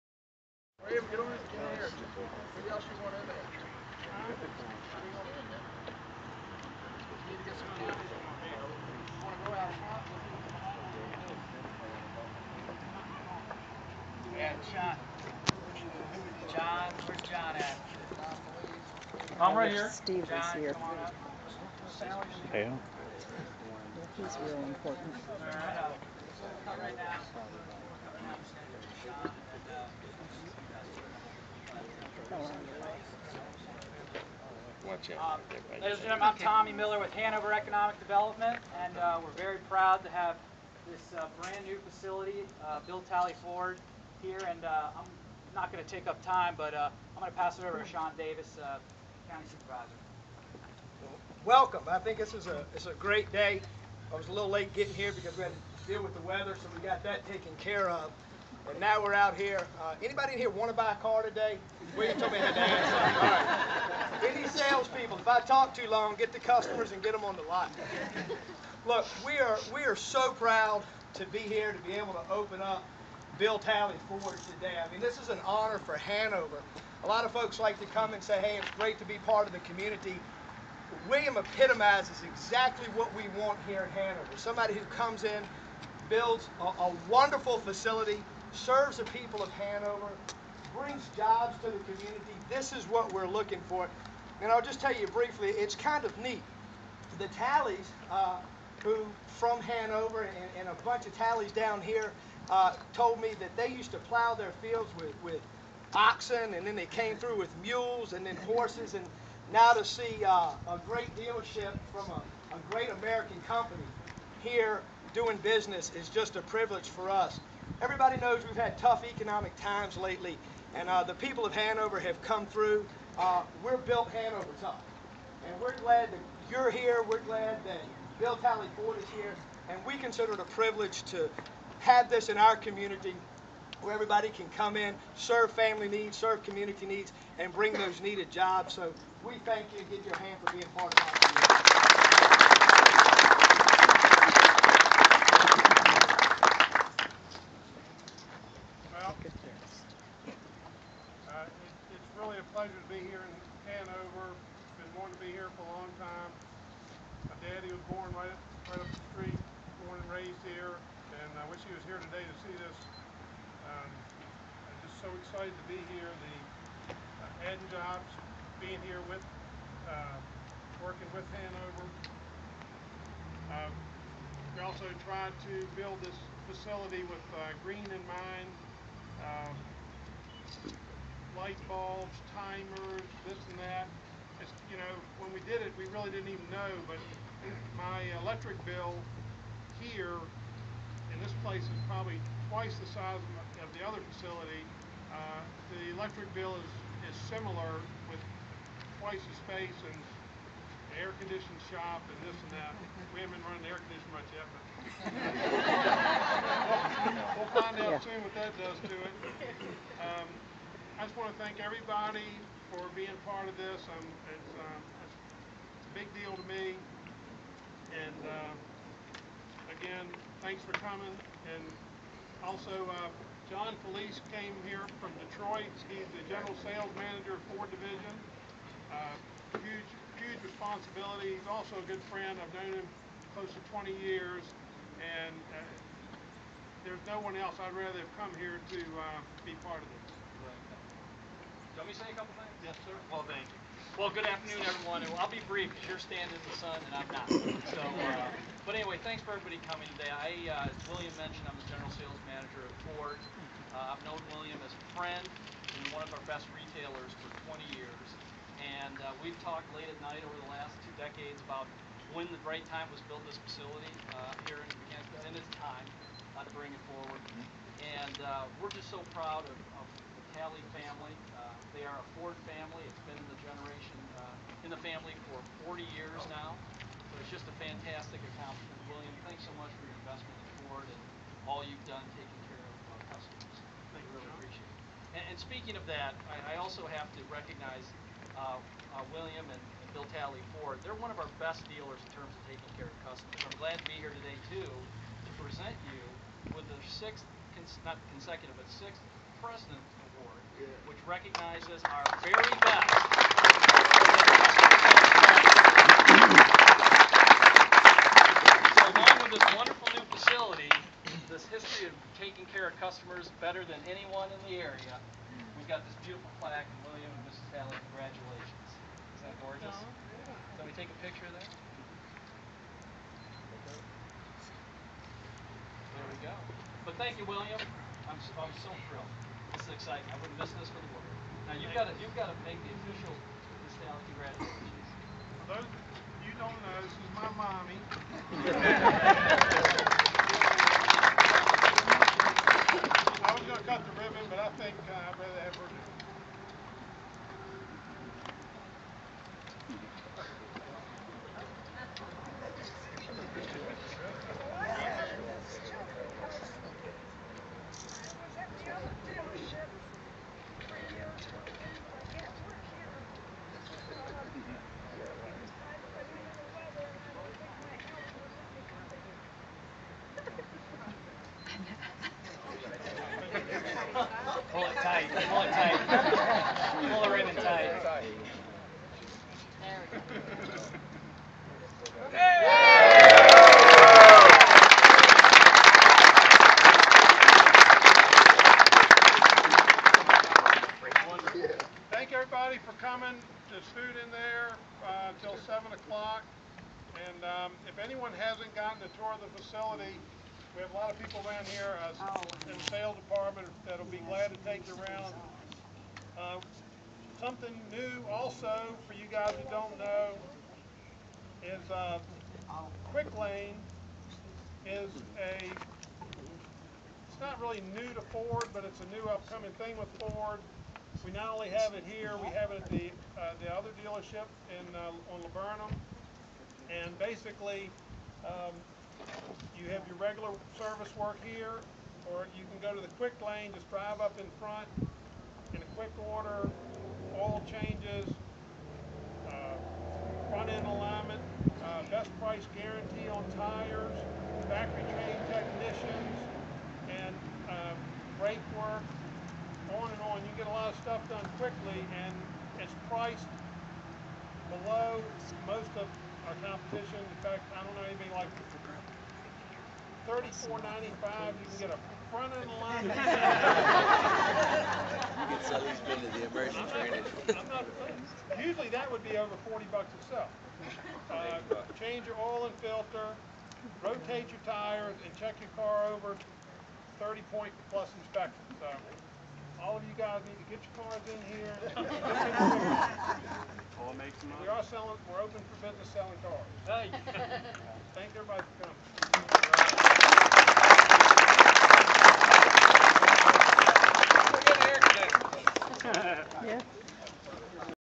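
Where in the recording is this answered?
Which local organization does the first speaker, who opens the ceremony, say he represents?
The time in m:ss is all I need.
0:37.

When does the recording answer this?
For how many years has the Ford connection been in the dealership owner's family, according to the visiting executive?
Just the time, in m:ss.
4:35.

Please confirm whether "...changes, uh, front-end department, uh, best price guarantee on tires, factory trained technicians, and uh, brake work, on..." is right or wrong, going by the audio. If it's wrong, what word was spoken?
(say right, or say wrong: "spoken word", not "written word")
wrong: "alignment", not "department".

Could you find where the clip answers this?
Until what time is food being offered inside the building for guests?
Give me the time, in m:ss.
6:35.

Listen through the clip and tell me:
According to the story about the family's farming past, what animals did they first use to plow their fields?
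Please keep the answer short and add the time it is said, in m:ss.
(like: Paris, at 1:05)
oxen, at 1:45.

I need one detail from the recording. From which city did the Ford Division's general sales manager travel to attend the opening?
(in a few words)
Detroit.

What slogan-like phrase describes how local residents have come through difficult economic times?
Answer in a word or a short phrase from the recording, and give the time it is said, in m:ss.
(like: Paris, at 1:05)
Hanover tough, at 2:04.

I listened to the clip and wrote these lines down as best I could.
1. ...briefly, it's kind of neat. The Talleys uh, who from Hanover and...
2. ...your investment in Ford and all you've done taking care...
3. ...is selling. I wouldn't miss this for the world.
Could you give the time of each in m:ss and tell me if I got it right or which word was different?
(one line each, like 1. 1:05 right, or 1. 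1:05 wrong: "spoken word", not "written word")
1. 1:35 right
2. 4:39 right
3. 5:29 wrong: "exciting", not "selling".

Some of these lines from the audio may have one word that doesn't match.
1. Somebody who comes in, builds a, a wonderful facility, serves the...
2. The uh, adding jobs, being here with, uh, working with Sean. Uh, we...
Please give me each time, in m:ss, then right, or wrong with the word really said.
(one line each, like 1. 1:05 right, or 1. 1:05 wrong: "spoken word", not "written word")
1. 1:24 right
2. 2:46 wrong: "Hanover", not "Sean".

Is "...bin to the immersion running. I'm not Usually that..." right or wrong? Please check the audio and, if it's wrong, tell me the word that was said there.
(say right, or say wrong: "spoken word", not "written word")
wrong: "training", not "running".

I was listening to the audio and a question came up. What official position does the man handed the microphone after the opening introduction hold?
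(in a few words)
County Supervisor.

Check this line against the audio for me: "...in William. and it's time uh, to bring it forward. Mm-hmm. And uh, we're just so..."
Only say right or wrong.
wrong.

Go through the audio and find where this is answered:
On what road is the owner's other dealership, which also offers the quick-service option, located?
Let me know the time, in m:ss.
7:05.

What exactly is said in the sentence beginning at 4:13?
Uh, I've known William as a friend and one of our best retailers for 20 years.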